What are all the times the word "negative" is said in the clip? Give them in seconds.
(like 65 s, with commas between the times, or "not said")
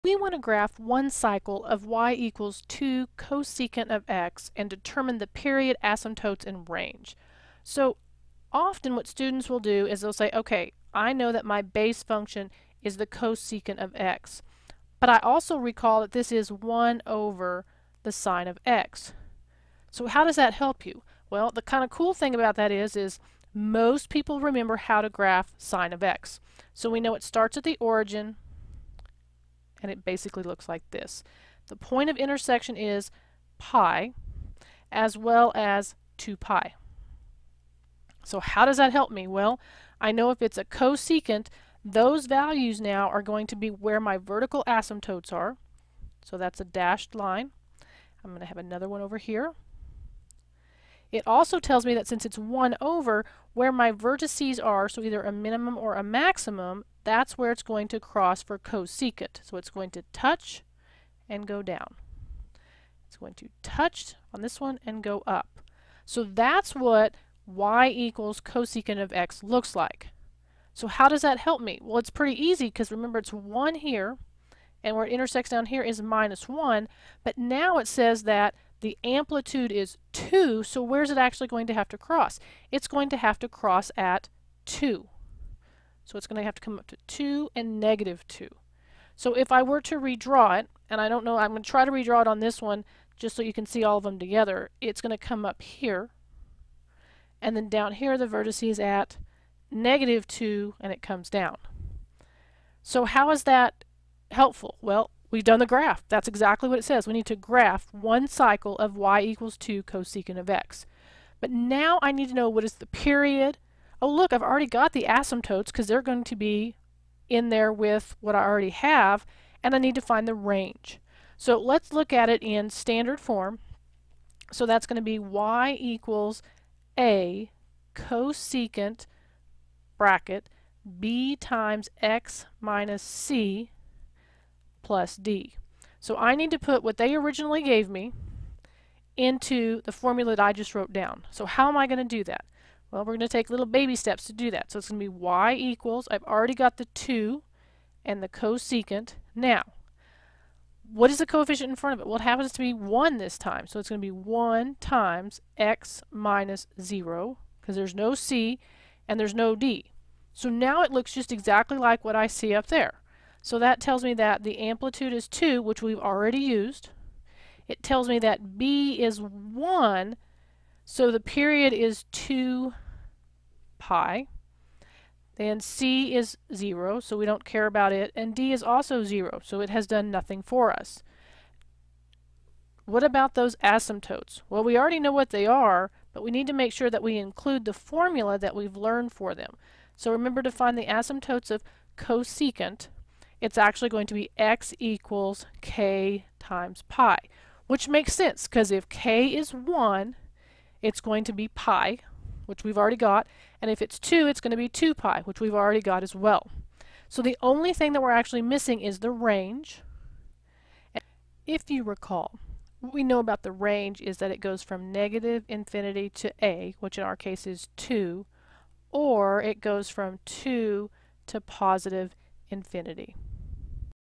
87 s, 99 s, 214 s.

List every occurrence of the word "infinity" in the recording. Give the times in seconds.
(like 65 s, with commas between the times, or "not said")
215 s, 222 s.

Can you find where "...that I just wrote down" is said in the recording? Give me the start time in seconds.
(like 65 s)
140 s.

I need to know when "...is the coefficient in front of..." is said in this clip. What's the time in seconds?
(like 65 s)
151 s.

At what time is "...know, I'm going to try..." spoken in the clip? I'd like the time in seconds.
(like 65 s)
91 s.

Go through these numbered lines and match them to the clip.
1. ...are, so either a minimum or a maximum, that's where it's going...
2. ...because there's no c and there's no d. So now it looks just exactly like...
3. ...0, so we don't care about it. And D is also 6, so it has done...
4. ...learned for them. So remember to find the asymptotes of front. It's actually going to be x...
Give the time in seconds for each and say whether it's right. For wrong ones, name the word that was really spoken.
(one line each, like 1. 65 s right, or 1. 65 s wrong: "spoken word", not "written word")
1. 54 s right
2. 157 s right
3. 176 s wrong: "0", not "6"
4. 188 s wrong: "cosecant", not "front".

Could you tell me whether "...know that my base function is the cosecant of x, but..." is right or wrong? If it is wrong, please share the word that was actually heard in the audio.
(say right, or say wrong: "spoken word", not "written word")
right.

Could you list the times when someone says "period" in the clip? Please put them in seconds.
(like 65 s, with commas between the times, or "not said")
5 s, 112 s, 171 s.